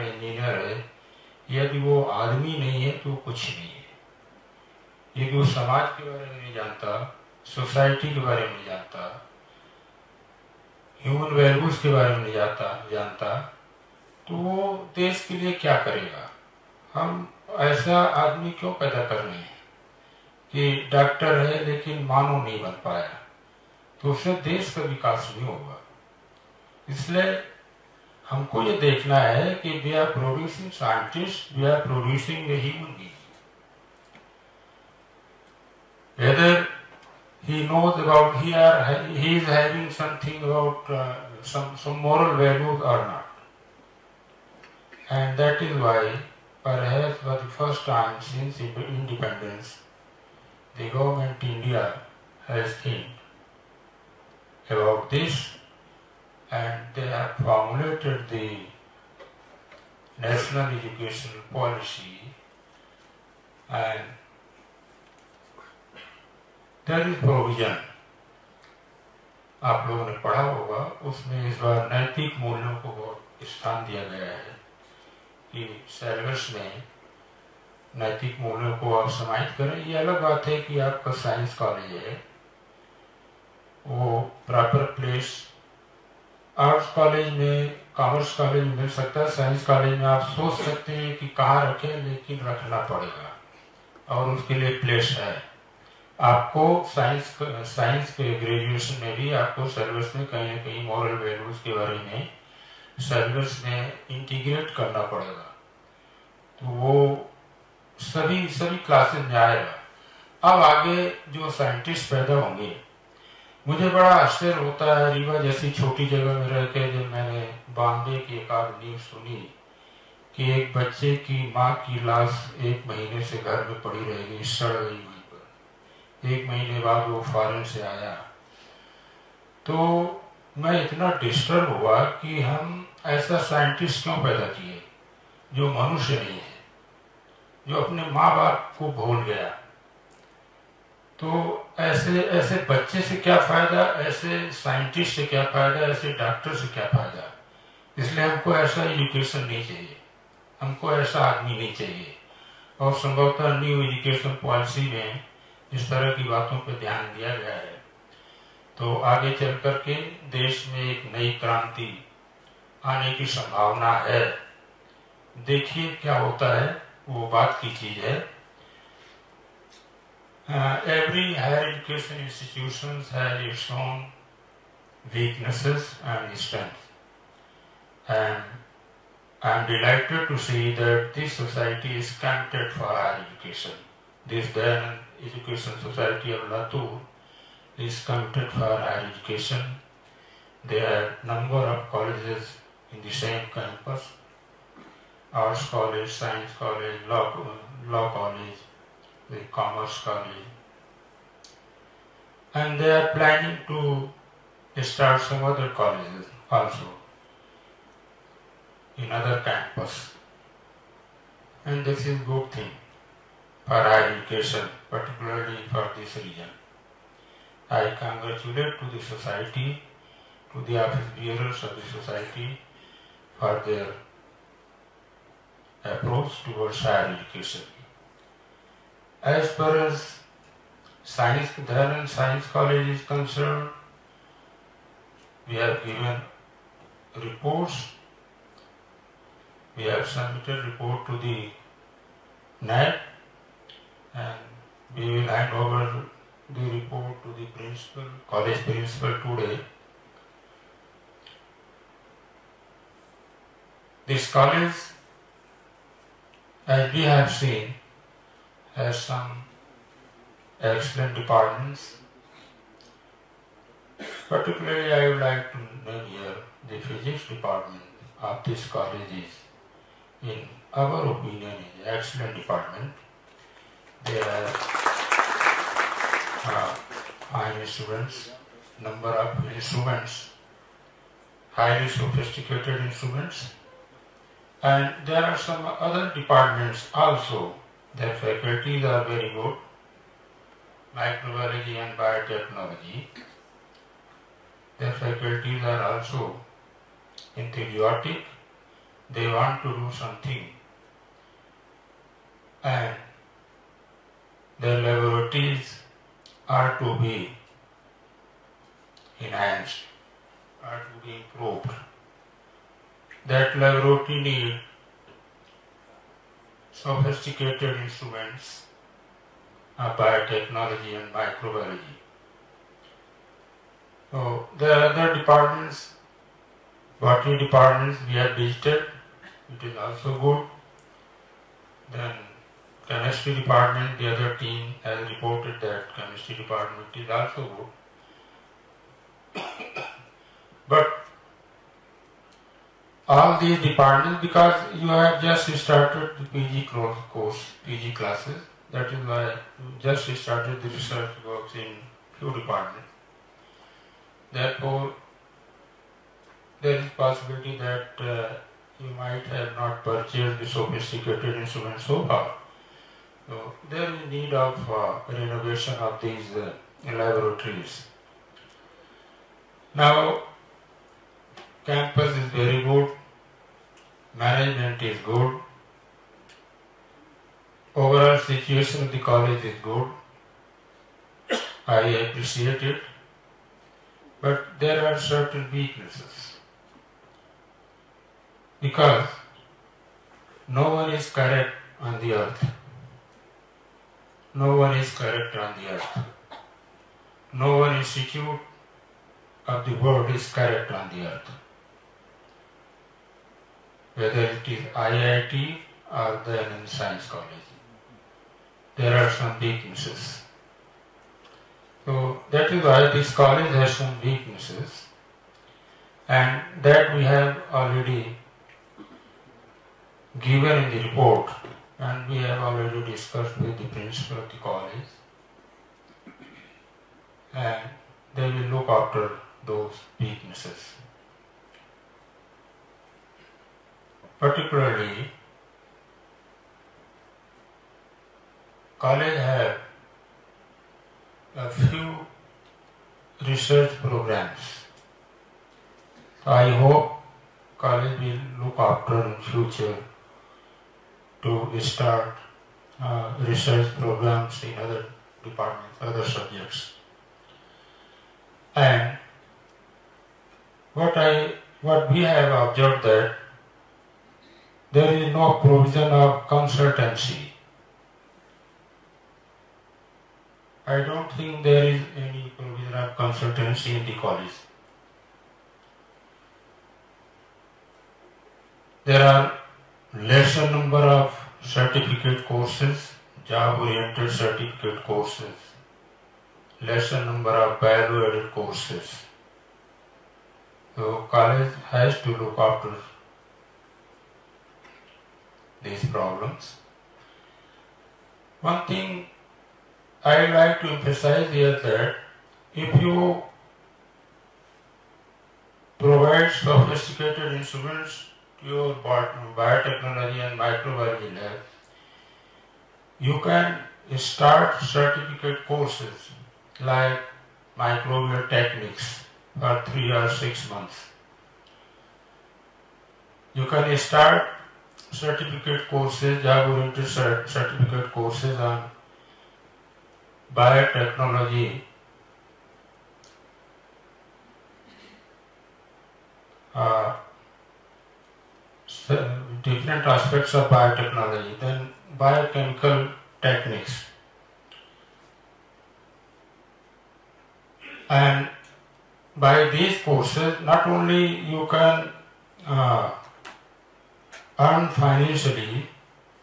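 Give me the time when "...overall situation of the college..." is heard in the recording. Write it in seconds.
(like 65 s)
377 s.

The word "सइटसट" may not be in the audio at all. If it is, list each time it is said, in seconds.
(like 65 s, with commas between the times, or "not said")
30 s, 111 s, 133 s, 144 s.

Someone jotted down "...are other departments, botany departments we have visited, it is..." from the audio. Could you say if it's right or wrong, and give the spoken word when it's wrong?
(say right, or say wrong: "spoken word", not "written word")
right.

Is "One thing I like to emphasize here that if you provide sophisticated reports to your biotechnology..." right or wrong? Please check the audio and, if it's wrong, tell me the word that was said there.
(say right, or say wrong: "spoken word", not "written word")
wrong: "instruments", not "reports".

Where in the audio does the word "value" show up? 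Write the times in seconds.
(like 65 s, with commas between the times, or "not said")
487 s.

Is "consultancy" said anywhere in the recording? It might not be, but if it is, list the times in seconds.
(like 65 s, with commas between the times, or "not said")
466 s, 472 s.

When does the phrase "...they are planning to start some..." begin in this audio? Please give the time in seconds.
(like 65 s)
202 s.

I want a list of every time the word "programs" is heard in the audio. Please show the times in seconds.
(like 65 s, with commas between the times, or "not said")
443 s, 453 s.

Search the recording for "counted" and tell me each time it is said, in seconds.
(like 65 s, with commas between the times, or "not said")
182 s.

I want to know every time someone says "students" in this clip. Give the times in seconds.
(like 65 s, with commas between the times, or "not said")
277 s.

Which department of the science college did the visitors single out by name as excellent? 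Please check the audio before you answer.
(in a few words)
Physics.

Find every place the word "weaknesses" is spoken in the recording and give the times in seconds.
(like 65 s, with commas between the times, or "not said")
175 s, 385 s, 409 s, 414 s, 429 s.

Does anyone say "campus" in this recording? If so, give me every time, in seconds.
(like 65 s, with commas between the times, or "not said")
193 s, 209 s, 371 s.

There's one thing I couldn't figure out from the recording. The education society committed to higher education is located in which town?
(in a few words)
Latur.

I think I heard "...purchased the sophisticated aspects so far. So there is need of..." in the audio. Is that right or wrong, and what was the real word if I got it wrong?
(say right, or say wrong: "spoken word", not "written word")
wrong: "instruments", not "aspects".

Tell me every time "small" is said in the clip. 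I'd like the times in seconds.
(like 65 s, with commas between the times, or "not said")
not said.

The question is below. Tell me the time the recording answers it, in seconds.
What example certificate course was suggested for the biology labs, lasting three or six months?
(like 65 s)
517 s.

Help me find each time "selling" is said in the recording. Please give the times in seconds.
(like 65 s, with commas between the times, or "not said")
not said.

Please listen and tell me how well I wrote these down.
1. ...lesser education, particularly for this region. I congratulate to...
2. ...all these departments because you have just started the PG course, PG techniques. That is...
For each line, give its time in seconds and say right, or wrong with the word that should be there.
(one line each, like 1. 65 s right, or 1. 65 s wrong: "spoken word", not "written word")
1. 213 s wrong: "higher", not "lesser"
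2. 343 s wrong: "classes", not "techniques".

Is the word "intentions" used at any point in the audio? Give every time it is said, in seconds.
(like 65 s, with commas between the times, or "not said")
not said.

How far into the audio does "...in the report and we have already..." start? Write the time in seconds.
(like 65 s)
420 s.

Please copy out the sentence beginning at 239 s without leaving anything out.
We have submitted report to the net, and we will hand over the report to the principal, college principal today.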